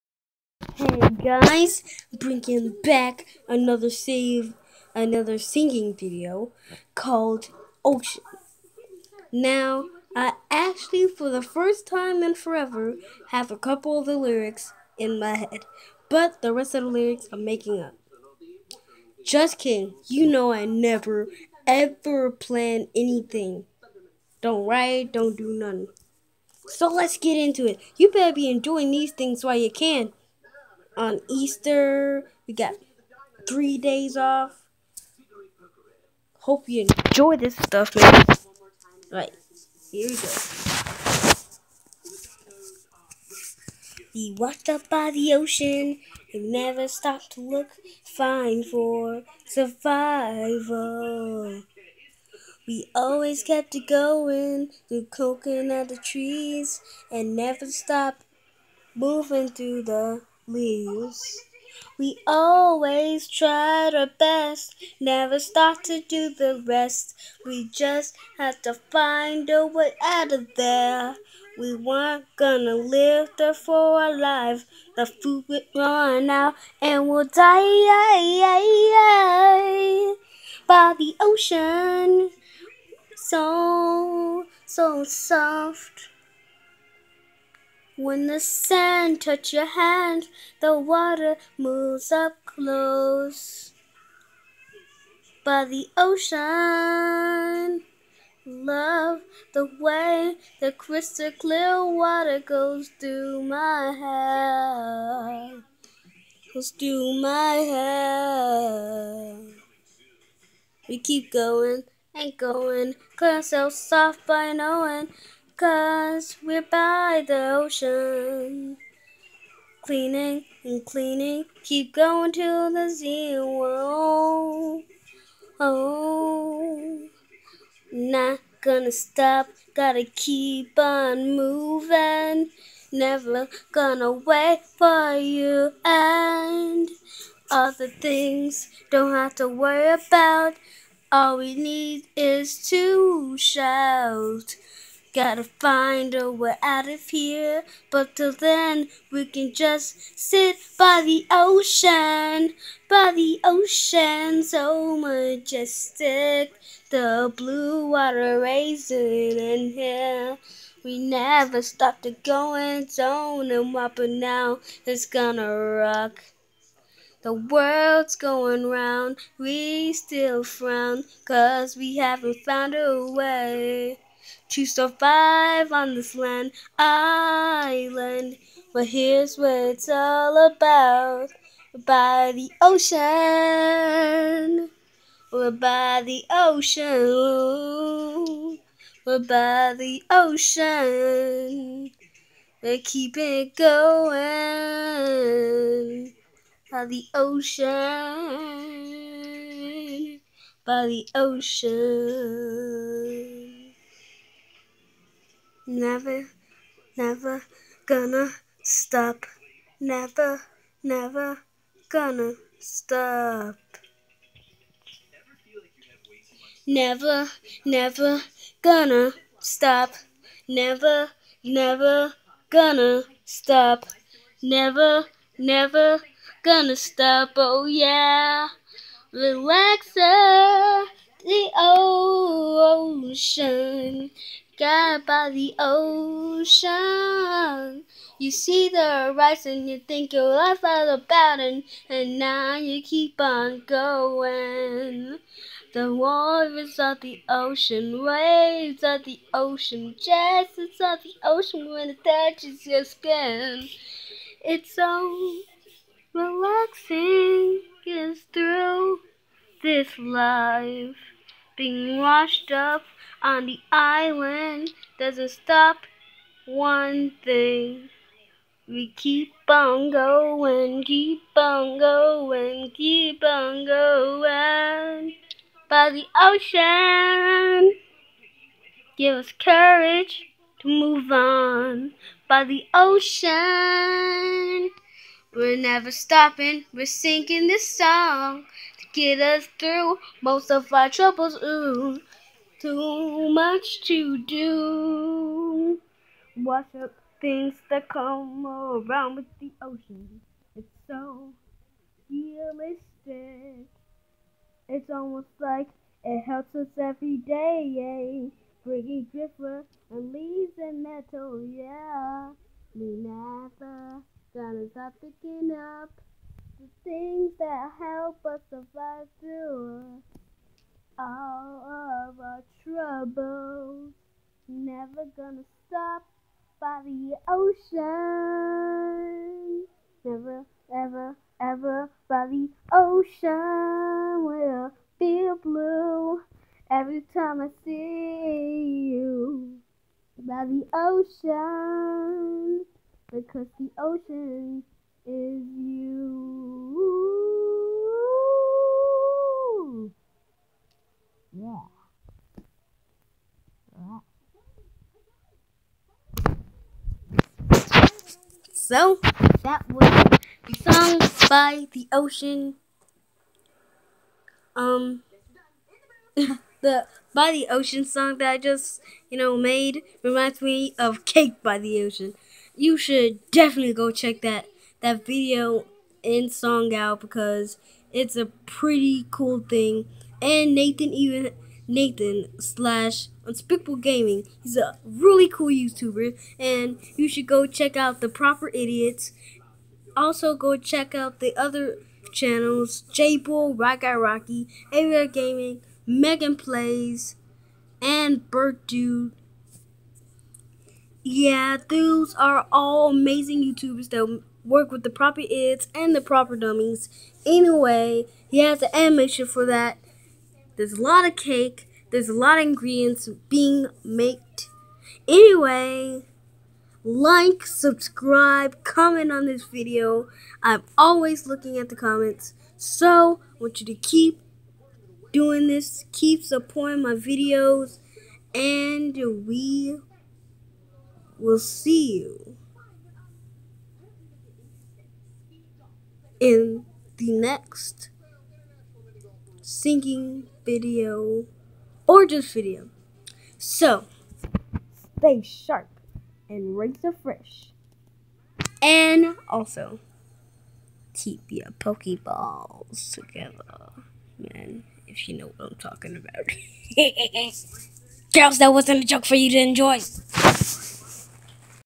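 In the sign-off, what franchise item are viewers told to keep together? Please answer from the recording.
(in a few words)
Pokeballs.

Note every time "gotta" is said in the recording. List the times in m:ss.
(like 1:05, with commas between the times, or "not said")
2:09, 2:25.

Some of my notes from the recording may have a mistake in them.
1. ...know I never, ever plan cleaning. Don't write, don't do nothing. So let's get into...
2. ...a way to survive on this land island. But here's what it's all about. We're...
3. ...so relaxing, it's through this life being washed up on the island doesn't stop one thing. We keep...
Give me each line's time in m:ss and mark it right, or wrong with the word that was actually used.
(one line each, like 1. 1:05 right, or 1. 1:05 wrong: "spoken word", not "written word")
1. 0:20 wrong: "anything", not "cleaning"
2. 2:52 right
3. 4:14 right.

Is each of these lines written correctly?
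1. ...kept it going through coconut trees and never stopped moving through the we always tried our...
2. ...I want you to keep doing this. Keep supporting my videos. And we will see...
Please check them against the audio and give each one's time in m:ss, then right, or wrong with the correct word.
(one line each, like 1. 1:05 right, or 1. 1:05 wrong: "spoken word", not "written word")
1. 0:53 right
2. 7:03 right.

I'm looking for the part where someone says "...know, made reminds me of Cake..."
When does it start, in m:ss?
6:09.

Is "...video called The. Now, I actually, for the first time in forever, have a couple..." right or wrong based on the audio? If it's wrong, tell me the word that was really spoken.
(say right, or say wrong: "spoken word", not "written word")
wrong: "Ocean", not "The".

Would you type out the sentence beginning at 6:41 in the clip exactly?
Yeah, those are all amazing YouTubers that work with the proper ids and the proper dummies.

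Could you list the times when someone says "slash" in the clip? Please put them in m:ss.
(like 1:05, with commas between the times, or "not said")
6:22.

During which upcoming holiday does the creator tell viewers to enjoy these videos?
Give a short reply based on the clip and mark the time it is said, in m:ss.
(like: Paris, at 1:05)
Easter, at 0:31.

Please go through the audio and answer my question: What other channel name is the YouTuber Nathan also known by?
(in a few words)
Unspeakable Gaming.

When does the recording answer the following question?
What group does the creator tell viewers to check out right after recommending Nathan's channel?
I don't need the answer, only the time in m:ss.
6:28.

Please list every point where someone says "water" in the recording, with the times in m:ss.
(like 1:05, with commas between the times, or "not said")
1:30, 1:41, 2:37, 4:05.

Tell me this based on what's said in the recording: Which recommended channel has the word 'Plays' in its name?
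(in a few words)
Megan Plays.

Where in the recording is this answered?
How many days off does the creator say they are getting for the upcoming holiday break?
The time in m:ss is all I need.
0:33.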